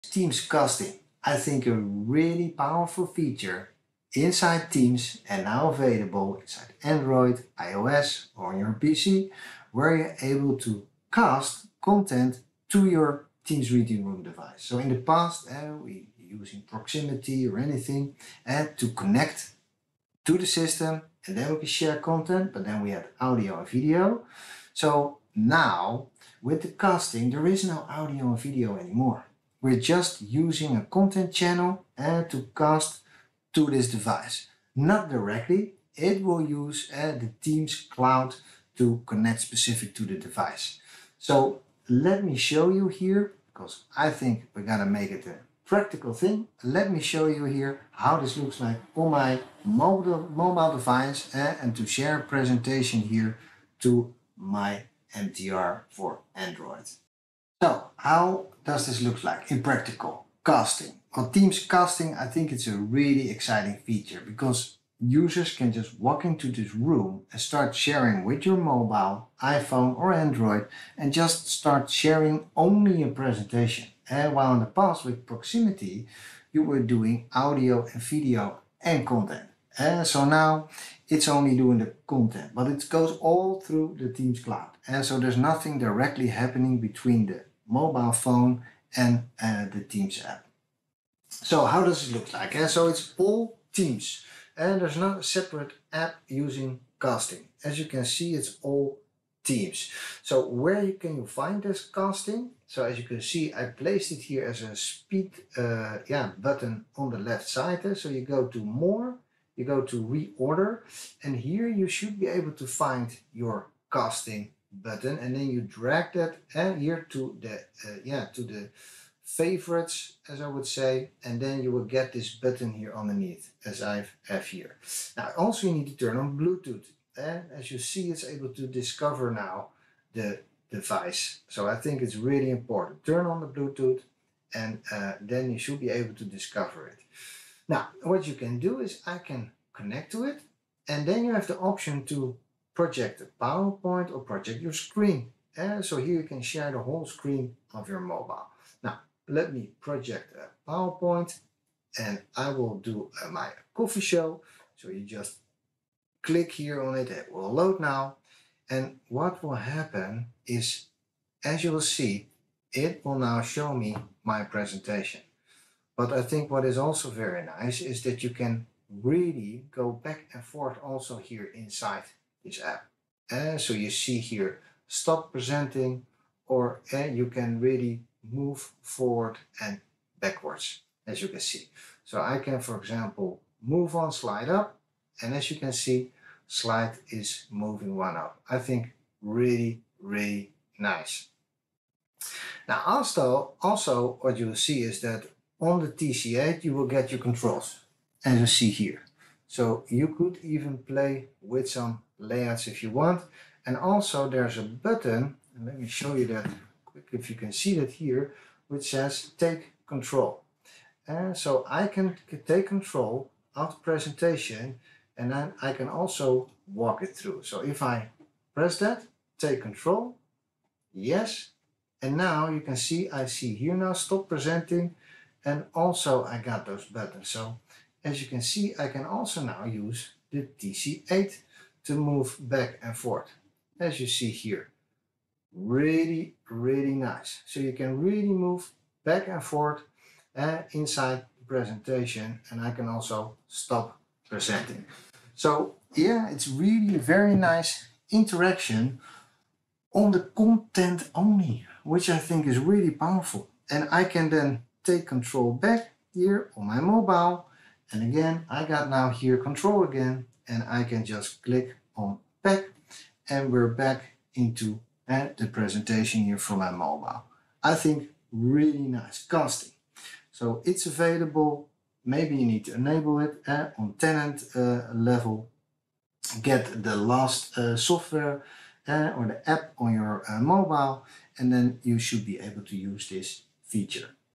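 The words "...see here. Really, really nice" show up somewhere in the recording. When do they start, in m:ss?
3:54.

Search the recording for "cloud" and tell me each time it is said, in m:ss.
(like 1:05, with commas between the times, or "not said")
0:37, 1:24.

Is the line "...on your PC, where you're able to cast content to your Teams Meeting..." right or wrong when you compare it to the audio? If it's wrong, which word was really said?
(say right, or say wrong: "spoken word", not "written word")
right.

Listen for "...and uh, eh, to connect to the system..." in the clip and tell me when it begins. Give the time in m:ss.
0:18.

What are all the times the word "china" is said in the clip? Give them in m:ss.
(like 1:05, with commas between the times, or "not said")
not said.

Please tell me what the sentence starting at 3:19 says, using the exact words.
So you could even play with some layouts if you want.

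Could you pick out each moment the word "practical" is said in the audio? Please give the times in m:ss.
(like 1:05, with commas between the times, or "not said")
0:45, 0:59.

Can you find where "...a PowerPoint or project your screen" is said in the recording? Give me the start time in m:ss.
2:23.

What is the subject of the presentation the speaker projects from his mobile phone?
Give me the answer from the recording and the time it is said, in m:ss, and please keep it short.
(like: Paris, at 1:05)
coffee, at 2:33.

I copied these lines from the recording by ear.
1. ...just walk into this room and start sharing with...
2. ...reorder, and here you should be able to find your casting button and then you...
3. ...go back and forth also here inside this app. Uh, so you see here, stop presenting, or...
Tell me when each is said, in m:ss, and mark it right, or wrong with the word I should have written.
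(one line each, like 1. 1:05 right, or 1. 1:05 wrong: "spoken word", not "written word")
1. 1:05 right
2. 1:50 right
3. 2:49 right.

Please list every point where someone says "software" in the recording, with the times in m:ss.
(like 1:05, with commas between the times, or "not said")
4:37.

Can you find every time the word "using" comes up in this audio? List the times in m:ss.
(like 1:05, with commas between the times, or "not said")
0:16, 0:30, 1:36.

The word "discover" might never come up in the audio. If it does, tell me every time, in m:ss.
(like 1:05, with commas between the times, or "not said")
2:08, 2:16.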